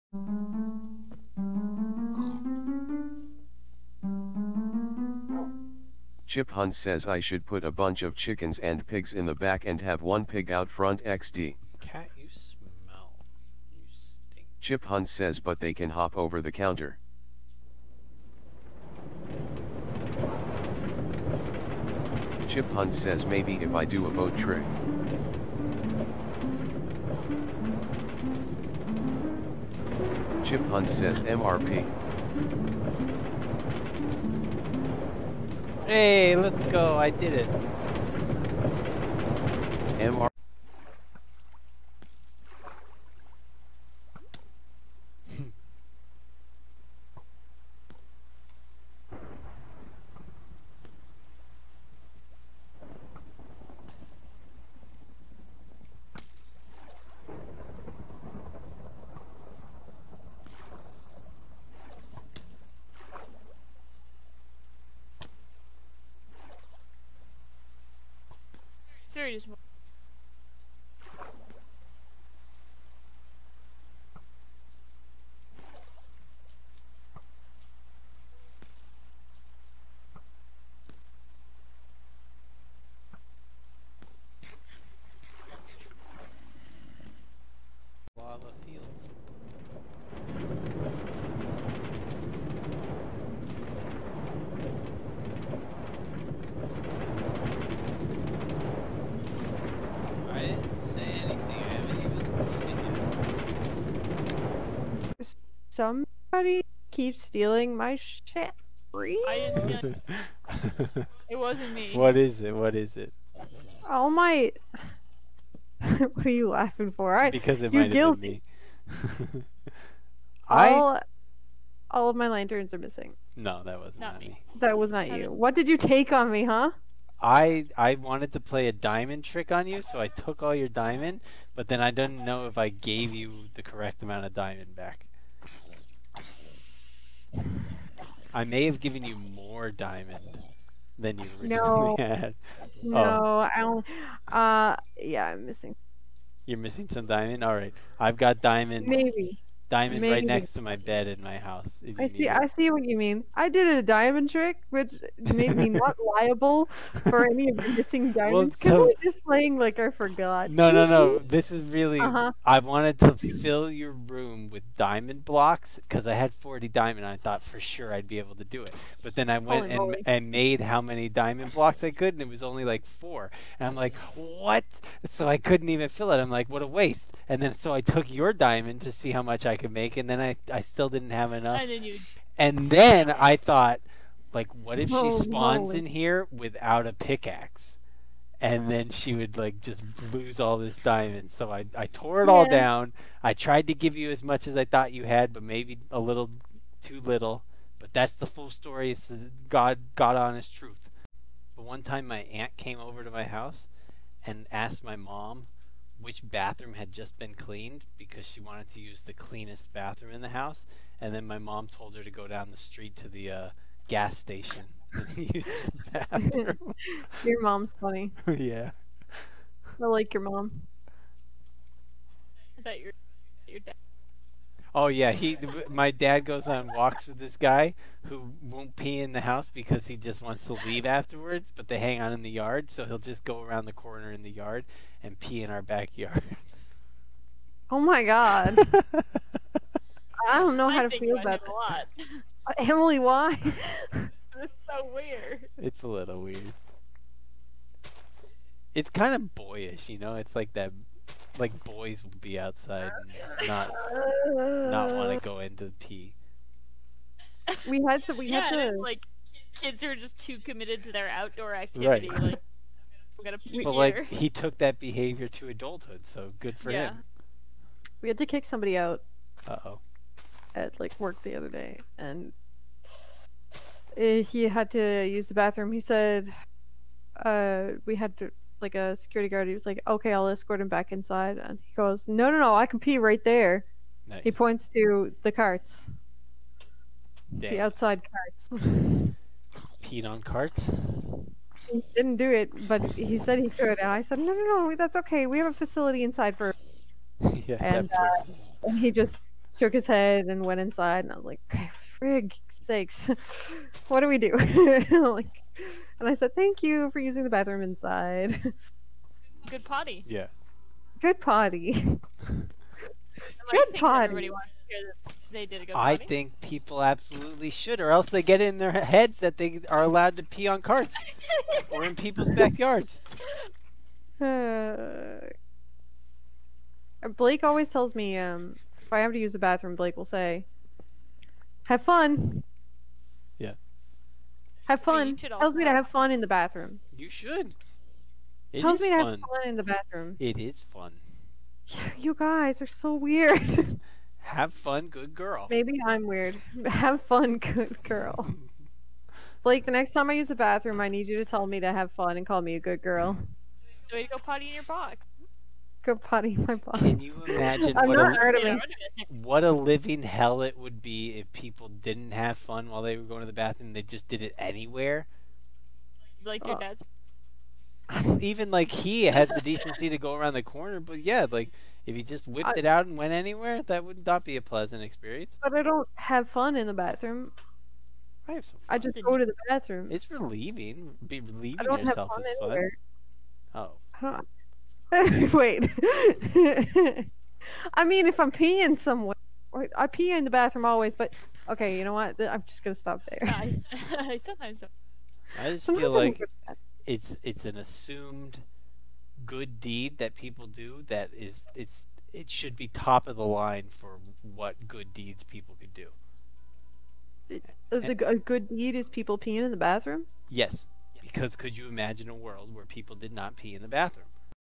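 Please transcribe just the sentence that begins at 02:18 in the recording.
I may have given you more diamond than you originally no.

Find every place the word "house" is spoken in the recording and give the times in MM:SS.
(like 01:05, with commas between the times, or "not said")
02:31, 03:23, 03:30, 03:49.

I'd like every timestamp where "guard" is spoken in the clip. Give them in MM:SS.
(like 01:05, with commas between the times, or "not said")
04:39.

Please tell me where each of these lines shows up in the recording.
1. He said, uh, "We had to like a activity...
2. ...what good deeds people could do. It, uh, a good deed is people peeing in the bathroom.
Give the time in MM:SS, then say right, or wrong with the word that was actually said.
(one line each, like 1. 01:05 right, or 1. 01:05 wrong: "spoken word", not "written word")
1. 04:35 wrong: "security", not "activity"
2. 06:44 right.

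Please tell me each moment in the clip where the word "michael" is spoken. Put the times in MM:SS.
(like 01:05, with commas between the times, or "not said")
not said.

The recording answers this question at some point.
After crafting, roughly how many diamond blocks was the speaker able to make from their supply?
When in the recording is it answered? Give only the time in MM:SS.
02:52.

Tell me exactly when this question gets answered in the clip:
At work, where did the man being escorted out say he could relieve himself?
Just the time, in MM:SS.
04:47.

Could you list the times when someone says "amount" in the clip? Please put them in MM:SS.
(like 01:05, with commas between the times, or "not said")
02:14.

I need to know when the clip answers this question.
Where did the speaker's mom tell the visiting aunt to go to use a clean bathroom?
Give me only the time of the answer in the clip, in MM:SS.
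03:33.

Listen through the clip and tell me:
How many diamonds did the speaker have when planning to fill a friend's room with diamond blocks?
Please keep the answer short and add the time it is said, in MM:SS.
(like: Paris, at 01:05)
40, at 02:46.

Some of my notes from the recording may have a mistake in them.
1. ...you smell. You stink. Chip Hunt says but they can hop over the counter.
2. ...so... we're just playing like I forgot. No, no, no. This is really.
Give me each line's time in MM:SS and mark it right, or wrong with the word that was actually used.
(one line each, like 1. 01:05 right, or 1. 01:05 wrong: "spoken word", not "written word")
1. 00:12 right
2. 02:38 right.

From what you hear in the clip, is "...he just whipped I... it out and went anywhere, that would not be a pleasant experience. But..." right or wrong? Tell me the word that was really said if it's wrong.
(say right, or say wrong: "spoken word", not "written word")
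right.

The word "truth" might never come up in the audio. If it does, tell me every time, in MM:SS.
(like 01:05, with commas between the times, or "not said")
03:20.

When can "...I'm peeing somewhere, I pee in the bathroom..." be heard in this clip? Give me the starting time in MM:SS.
06:28.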